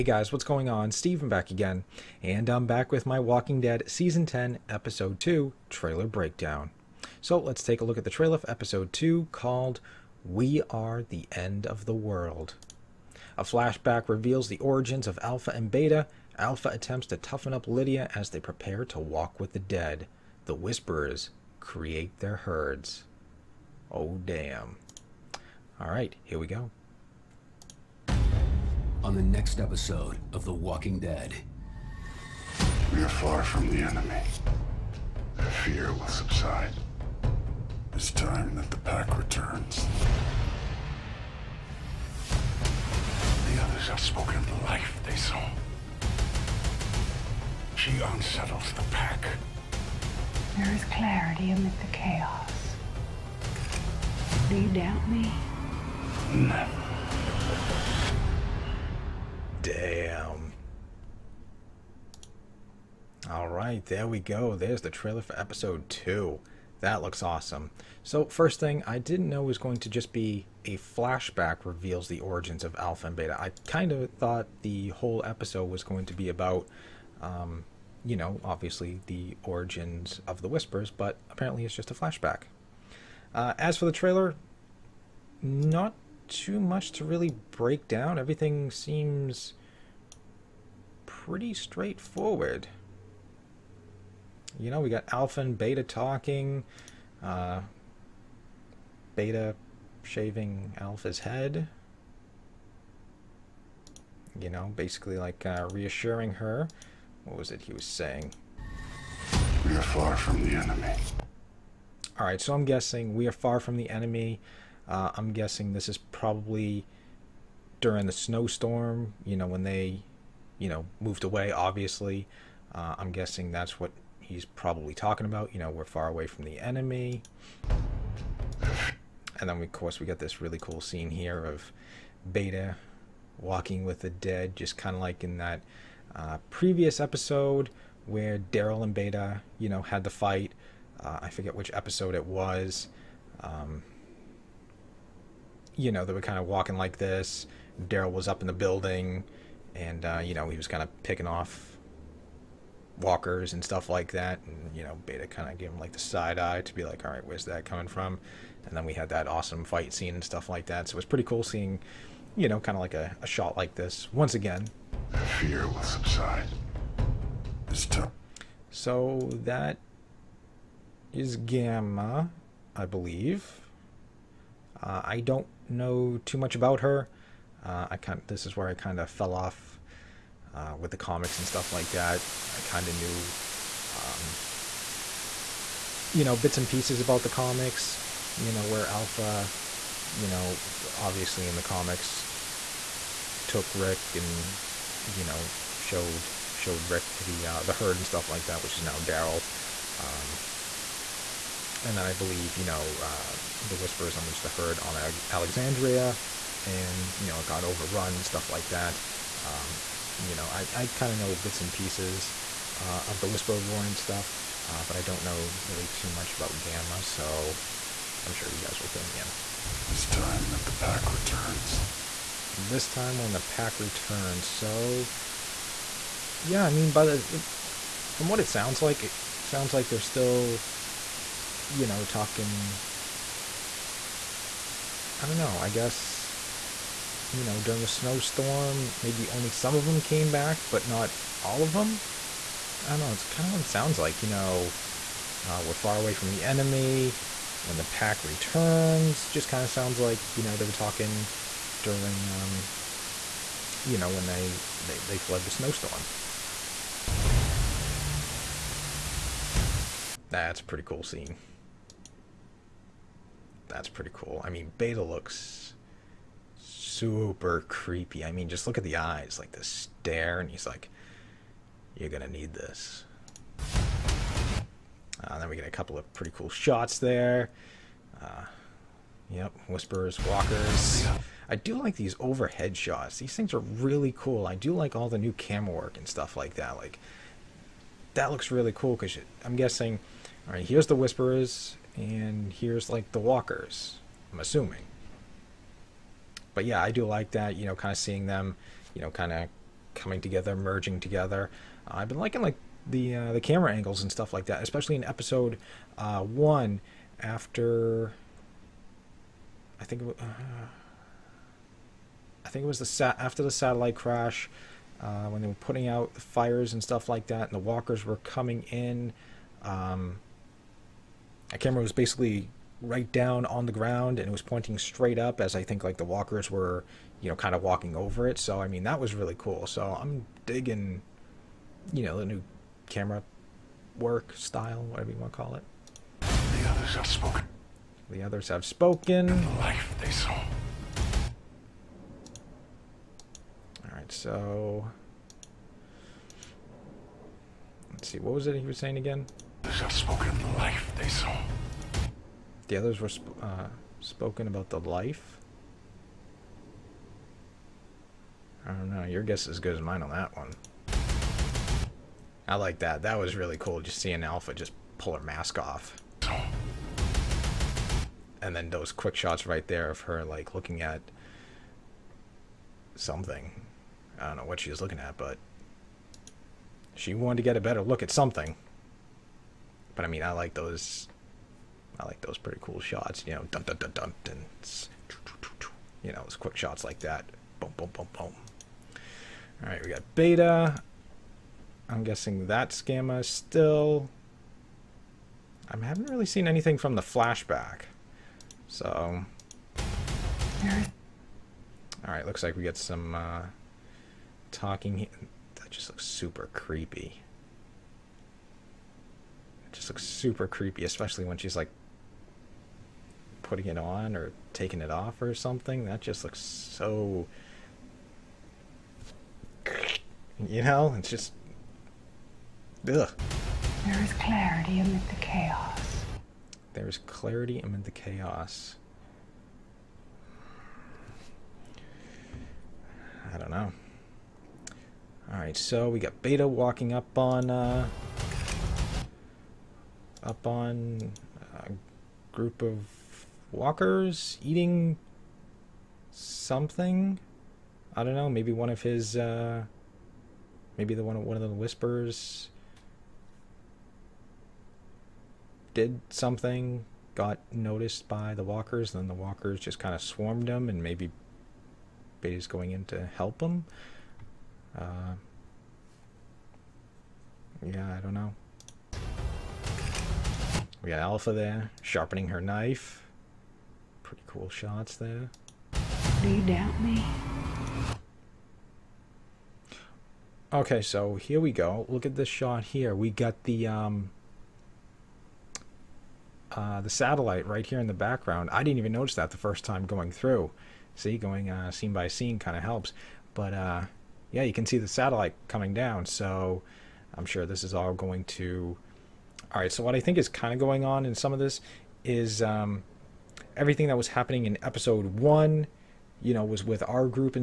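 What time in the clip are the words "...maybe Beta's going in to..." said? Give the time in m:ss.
7:40.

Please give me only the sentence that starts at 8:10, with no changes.
See, going uh, scene by scene kind of helps.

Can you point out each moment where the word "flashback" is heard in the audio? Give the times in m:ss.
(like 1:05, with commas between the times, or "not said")
0:13, 1:10, 1:21, 6:37.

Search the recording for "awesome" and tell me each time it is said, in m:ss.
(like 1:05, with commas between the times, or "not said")
1:07, 2:39.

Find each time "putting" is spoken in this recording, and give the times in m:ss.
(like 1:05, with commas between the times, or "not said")
5:15, 6:53.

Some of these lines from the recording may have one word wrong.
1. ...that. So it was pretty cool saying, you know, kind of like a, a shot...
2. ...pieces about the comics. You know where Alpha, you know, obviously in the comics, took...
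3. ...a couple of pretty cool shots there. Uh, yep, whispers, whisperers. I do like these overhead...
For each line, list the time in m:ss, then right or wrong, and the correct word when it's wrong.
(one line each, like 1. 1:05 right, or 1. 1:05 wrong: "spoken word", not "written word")
1. 2:40 wrong: "seeing", not "saying"
2. 3:06 right
3. 4:35 wrong: "walkers", not "whisperers".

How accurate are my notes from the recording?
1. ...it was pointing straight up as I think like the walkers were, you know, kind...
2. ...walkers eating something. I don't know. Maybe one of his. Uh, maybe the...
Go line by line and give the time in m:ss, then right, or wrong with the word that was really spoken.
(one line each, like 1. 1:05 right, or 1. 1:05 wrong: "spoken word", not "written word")
1. 5:24 right
2. 7:23 right.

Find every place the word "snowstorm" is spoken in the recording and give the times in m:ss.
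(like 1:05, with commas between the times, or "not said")
1:58, 3:57, 4:15.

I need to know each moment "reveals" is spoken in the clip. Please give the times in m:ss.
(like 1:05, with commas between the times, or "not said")
0:14, 1:11.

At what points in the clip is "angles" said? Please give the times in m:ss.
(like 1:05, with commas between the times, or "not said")
5:03.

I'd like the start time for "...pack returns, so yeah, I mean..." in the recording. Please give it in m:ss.
3:43.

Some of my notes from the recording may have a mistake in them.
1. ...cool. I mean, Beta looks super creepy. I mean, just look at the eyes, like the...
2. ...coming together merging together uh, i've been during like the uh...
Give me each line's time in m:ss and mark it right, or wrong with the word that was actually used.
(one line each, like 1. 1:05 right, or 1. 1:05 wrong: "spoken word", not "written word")
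1. 4:24 right
2. 4:59 wrong: "liking", not "during".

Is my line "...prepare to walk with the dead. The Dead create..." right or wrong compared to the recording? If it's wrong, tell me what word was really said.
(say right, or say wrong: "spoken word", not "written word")
wrong: "Whisperers", not "Dead".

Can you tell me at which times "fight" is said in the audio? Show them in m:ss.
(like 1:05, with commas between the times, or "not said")
2:20, 2:39.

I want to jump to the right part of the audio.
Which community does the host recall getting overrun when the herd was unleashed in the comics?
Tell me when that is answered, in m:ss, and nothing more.
3:25.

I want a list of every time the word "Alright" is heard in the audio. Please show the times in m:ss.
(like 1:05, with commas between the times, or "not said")
6:42, 7:15.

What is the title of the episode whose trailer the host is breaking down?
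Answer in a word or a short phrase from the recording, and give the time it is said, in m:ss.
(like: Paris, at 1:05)
We Are the End of the World, at 0:10.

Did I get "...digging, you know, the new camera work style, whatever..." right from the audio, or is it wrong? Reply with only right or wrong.
right.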